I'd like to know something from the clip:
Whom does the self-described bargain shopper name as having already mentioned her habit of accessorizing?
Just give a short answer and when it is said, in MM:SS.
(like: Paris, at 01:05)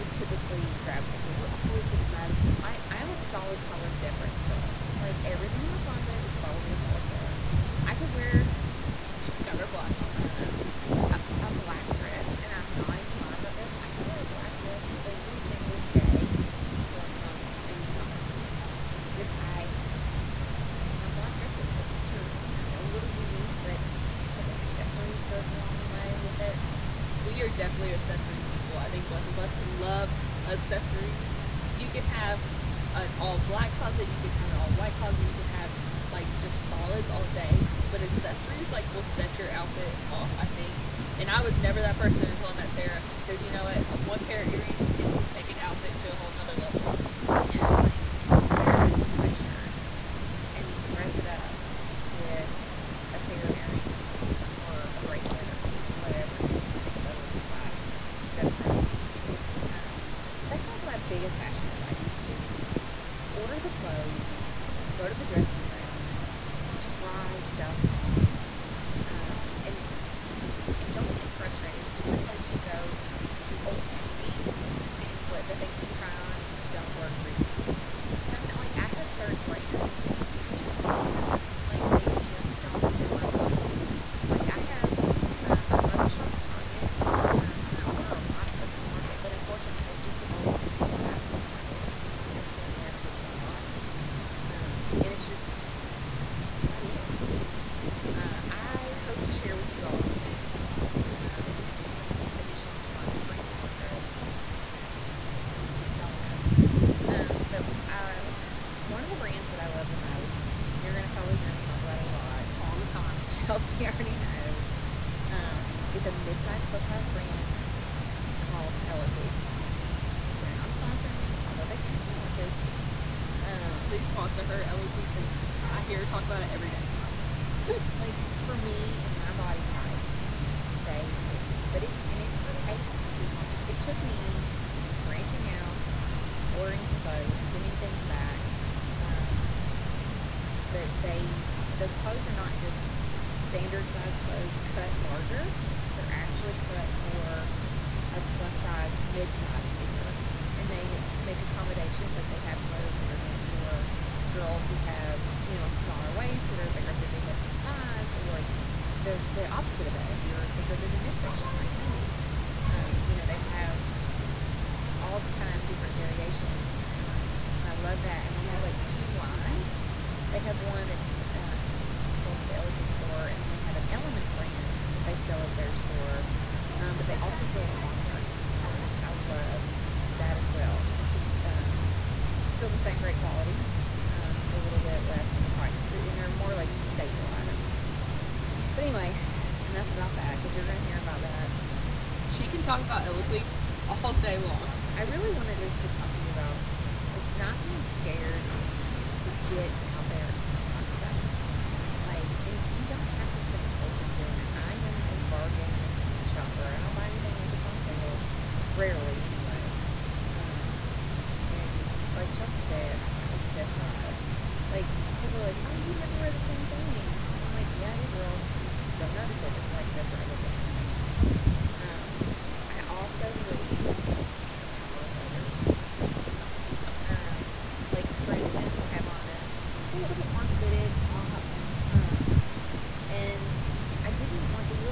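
Chelsea, at 03:32.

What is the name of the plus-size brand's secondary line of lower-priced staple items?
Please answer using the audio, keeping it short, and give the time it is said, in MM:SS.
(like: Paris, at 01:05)
Elements, at 02:53.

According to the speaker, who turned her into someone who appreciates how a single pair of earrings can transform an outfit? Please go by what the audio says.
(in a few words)
Sarah.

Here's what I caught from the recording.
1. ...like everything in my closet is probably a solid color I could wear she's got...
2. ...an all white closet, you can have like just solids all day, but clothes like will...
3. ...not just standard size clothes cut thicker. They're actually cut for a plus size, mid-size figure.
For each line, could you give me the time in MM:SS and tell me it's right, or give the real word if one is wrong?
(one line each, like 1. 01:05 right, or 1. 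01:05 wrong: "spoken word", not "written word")
1. 00:05 right
2. 00:34 wrong: "accessories", not "clothes"
3. 02:22 wrong: "larger", not "thicker".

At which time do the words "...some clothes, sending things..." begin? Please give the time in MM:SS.
02:16.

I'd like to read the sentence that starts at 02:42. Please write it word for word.
Um, you know, they have all kind of different variations.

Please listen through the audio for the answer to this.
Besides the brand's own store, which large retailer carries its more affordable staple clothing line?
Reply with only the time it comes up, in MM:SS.
02:57.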